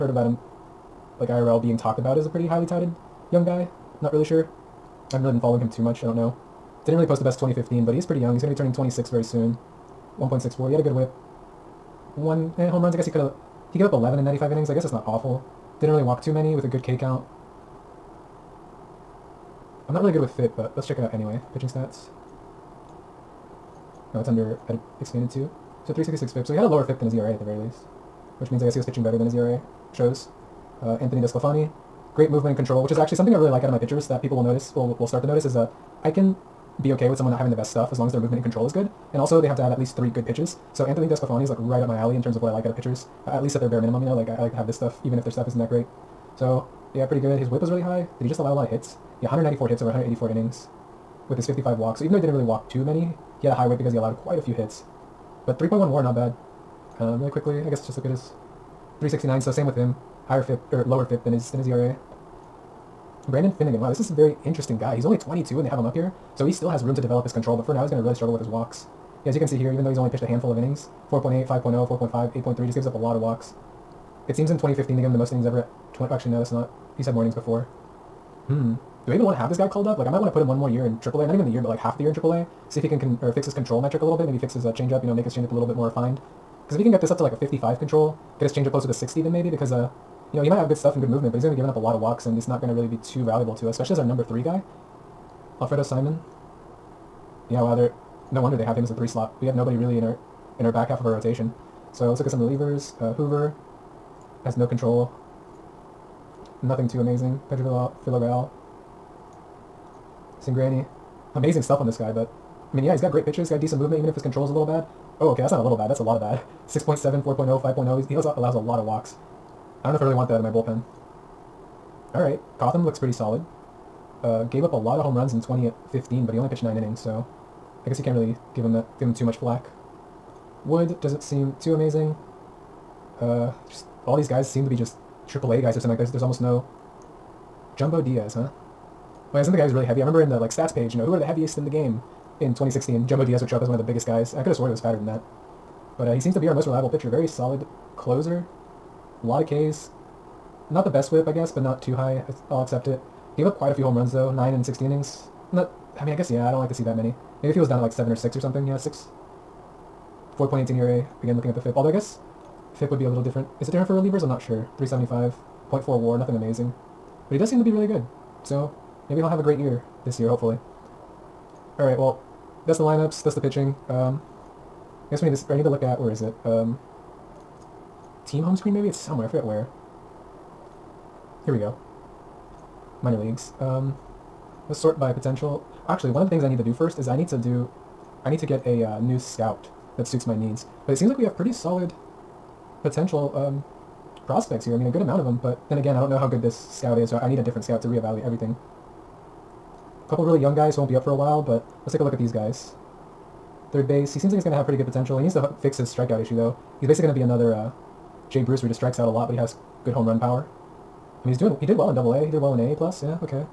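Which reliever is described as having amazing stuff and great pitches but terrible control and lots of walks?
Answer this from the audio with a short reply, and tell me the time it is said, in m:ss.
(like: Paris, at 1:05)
Cingrani, at 1:50.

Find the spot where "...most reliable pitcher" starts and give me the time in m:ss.
2:26.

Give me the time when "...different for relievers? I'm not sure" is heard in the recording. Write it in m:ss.
2:43.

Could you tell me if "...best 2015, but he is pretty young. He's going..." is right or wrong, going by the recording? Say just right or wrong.
right.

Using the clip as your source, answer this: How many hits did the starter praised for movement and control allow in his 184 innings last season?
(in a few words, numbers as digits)
194.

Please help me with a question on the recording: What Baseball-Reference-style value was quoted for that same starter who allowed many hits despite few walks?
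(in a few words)
3.1 WAR.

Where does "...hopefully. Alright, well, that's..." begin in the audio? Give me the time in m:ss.
2:50.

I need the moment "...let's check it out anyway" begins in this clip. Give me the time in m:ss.
0:20.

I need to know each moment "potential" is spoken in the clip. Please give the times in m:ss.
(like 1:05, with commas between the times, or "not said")
3:05, 3:12, 3:24.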